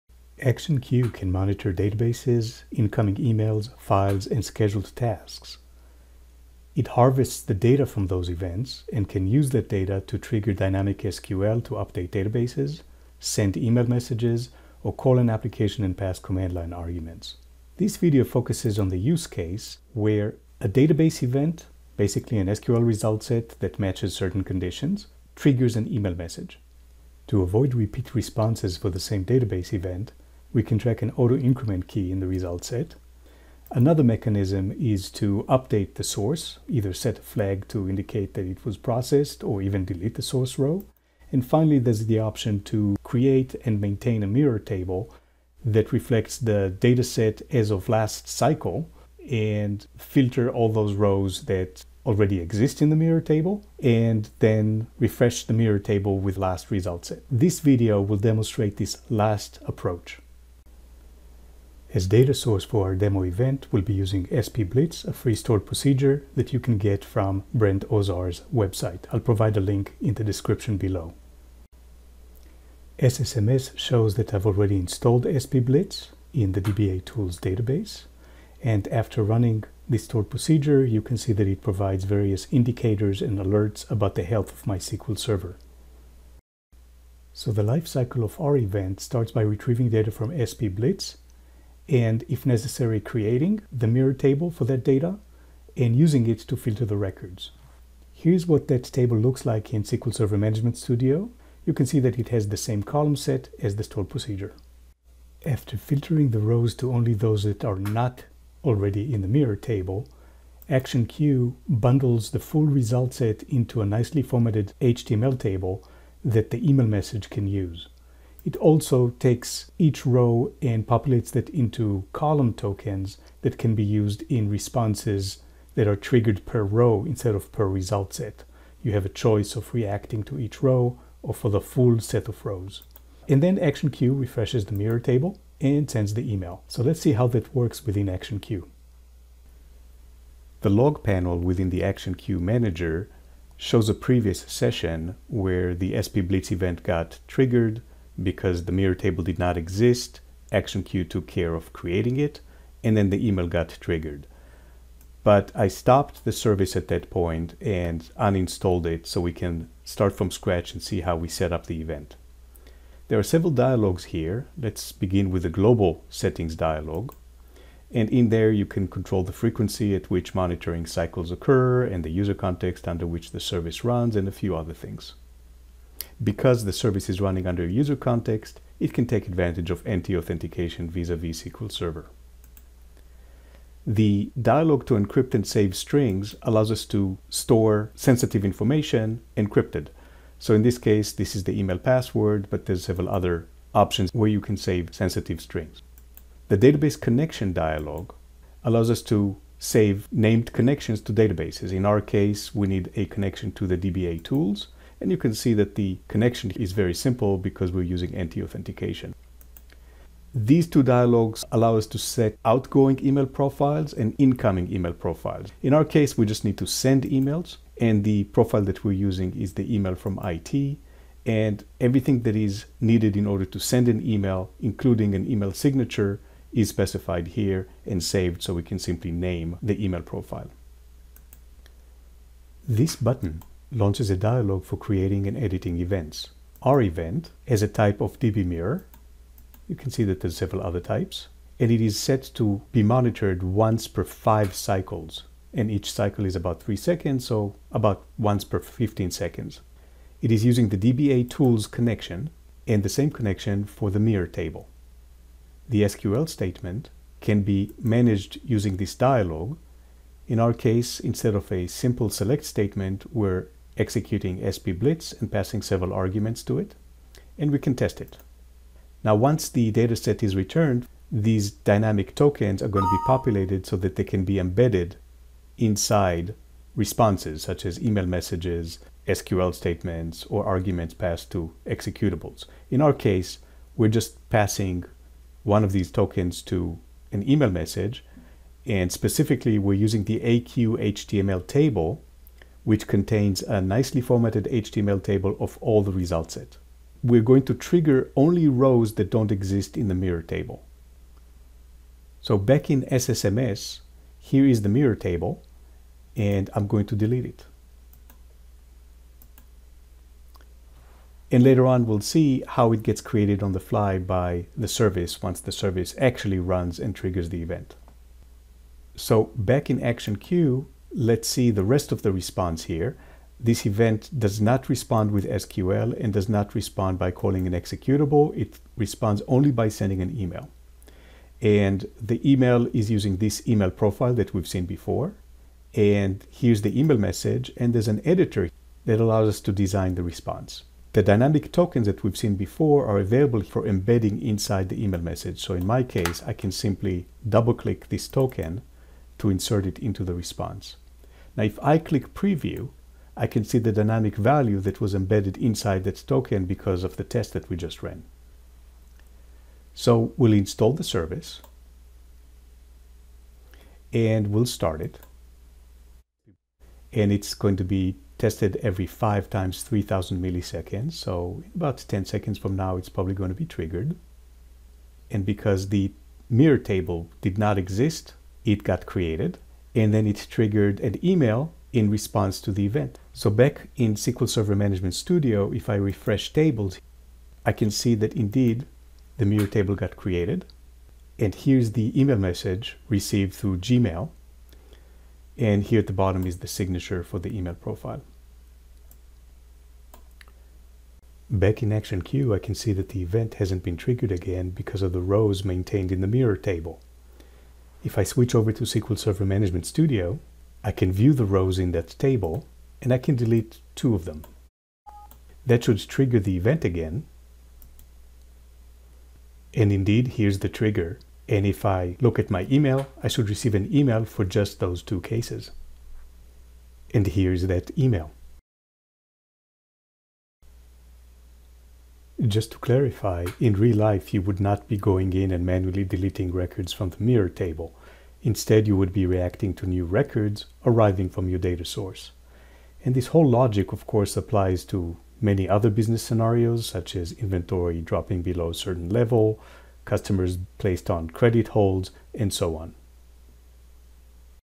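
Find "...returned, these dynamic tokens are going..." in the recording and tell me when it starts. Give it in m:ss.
4:30.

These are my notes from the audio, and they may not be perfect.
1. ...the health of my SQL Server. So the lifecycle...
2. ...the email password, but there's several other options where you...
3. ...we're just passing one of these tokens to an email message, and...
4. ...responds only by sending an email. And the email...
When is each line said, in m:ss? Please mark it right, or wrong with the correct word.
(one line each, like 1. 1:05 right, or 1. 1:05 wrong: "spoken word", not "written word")
1. 1:24 right
2. 3:11 right
3. 4:43 right
4. 5:28 right.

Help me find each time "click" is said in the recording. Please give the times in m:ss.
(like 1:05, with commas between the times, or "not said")
5:47, 5:51.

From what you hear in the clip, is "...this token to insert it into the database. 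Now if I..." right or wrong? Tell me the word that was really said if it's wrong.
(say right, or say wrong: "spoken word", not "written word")
wrong: "response", not "database".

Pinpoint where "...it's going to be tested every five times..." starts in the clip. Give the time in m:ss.
6:07.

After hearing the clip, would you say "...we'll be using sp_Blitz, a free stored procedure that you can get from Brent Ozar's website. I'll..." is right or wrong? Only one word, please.
right.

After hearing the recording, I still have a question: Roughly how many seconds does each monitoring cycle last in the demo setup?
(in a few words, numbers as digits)
3 seconds.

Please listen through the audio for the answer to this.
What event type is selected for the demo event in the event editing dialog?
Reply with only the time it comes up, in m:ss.
3:58.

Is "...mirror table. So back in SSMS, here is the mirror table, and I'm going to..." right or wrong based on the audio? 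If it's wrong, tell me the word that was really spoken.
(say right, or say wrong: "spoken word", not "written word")
right.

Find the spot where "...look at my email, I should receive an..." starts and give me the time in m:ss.
7:01.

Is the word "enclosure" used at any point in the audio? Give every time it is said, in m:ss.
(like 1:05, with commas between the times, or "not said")
not said.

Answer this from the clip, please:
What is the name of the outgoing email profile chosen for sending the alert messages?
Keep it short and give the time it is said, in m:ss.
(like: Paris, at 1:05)
email from IT, at 3:39.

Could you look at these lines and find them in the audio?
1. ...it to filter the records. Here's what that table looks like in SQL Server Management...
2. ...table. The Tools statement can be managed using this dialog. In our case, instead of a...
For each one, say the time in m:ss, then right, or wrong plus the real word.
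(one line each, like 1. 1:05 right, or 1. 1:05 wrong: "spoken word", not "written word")
1. 1:36 right
2. 4:14 wrong: "SQL", not "Tools".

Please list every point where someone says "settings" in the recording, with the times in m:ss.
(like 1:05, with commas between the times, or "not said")
2:46.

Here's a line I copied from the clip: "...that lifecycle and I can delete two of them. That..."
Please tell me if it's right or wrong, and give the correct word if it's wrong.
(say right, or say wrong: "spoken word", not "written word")
wrong: "table", not "lifecycle".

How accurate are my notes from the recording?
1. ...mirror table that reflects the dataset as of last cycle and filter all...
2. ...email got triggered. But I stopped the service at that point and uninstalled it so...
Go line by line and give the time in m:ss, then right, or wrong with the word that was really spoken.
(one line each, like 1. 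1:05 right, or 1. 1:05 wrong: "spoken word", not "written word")
1. 0:44 right
2. 2:33 right.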